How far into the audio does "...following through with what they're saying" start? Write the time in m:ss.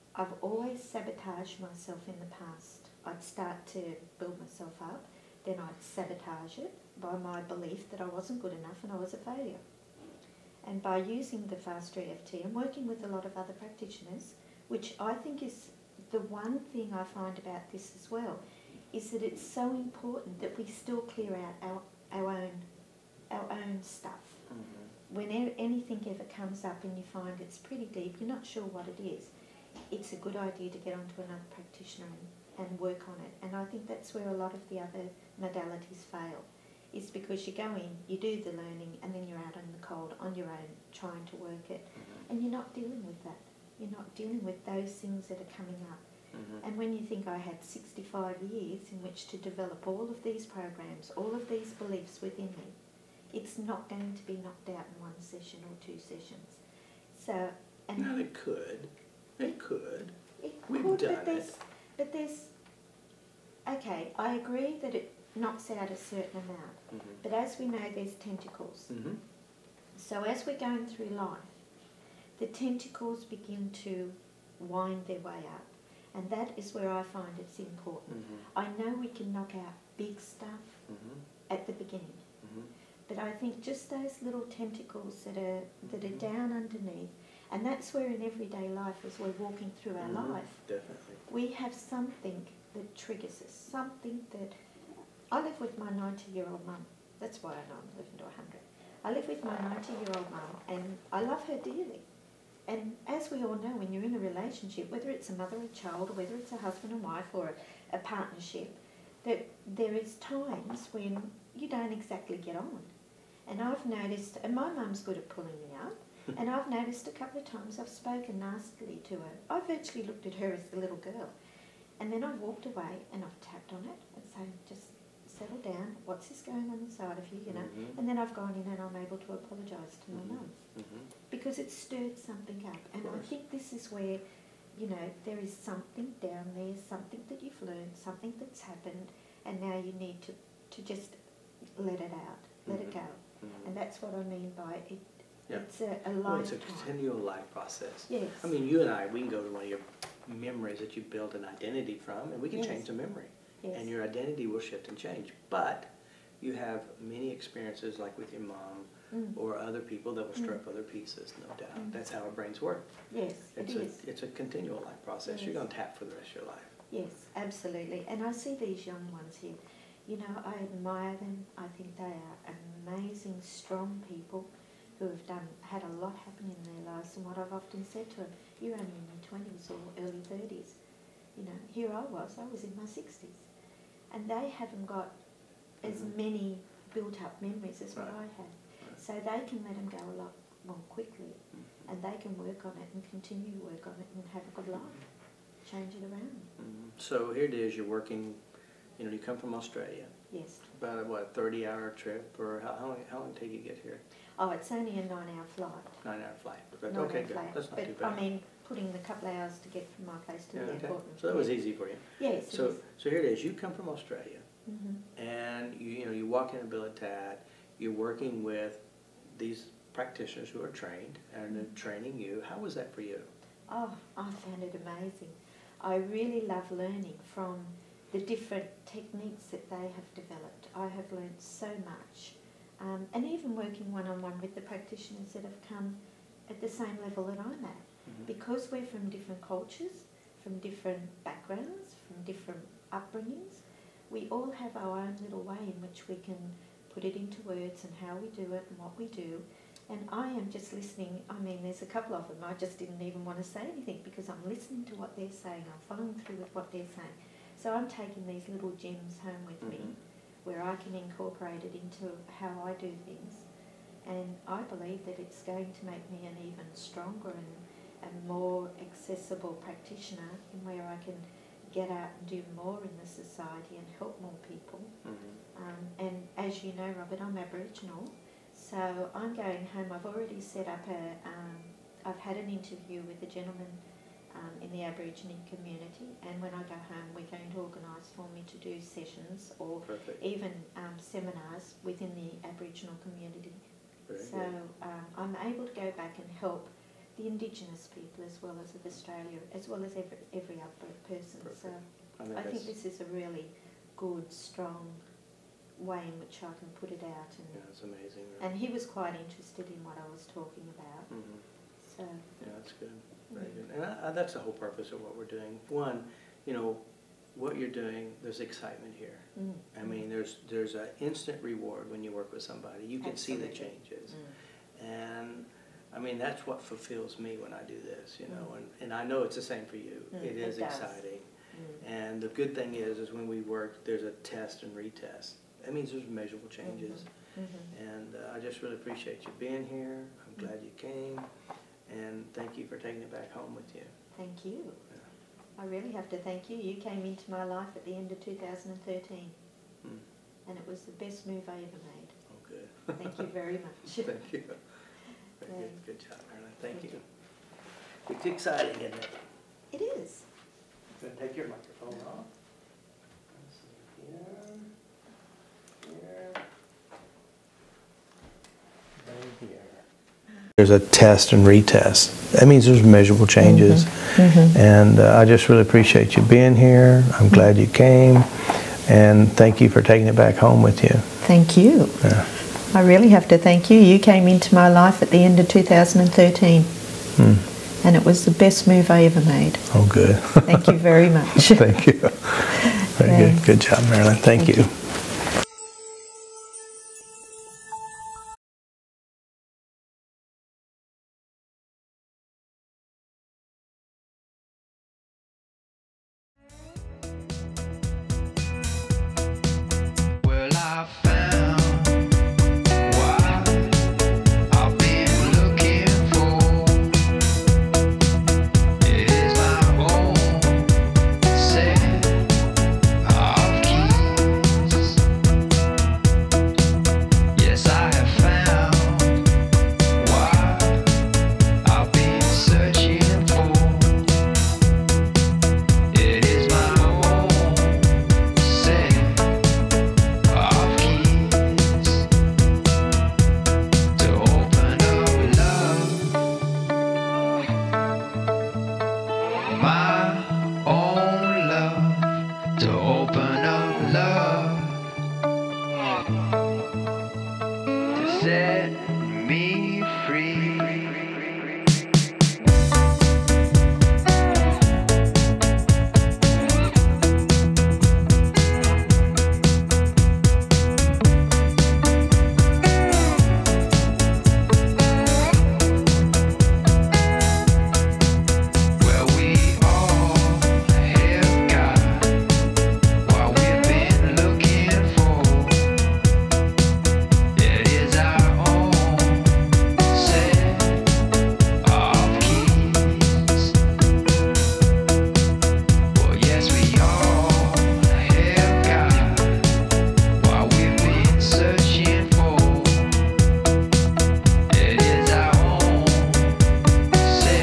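4:15.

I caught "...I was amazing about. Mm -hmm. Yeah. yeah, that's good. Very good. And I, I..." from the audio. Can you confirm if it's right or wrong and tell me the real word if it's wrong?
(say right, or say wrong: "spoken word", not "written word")
wrong: "talking", not "amazing".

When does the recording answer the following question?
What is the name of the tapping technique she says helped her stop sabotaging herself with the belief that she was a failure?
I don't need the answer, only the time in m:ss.
0:11.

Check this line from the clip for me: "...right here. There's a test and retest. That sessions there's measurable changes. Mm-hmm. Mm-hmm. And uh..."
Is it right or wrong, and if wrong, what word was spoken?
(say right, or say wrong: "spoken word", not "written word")
wrong: "means", not "sessions".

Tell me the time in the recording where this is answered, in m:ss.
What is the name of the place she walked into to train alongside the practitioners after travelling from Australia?
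3:36.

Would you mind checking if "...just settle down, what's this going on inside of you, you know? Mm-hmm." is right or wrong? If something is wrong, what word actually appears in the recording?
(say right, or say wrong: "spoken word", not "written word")
right.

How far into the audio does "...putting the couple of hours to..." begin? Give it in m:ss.
3:28.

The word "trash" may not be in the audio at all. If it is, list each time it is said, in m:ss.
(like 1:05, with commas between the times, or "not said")
not said.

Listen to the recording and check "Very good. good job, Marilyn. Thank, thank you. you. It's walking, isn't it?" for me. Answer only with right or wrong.
wrong.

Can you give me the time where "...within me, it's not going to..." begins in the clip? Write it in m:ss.
0:52.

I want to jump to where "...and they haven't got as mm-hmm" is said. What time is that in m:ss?
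3:04.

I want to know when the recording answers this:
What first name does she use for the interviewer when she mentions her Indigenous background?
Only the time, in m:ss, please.
4:36.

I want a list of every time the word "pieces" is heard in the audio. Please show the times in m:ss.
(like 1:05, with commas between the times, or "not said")
2:40.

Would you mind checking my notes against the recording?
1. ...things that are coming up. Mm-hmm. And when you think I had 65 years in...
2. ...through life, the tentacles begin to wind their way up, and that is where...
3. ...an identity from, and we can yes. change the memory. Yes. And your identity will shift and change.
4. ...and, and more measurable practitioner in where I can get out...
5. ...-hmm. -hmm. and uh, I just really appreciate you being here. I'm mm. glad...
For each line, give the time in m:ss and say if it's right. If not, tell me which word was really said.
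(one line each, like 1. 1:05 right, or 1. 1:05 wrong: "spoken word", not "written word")
1. 0:44 right
2. 1:10 right
3. 2:31 right
4. 4:27 wrong: "accessible", not "measurable"
5. 5:37 right.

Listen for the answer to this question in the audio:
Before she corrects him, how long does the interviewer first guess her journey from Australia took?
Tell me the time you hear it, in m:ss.
3:21.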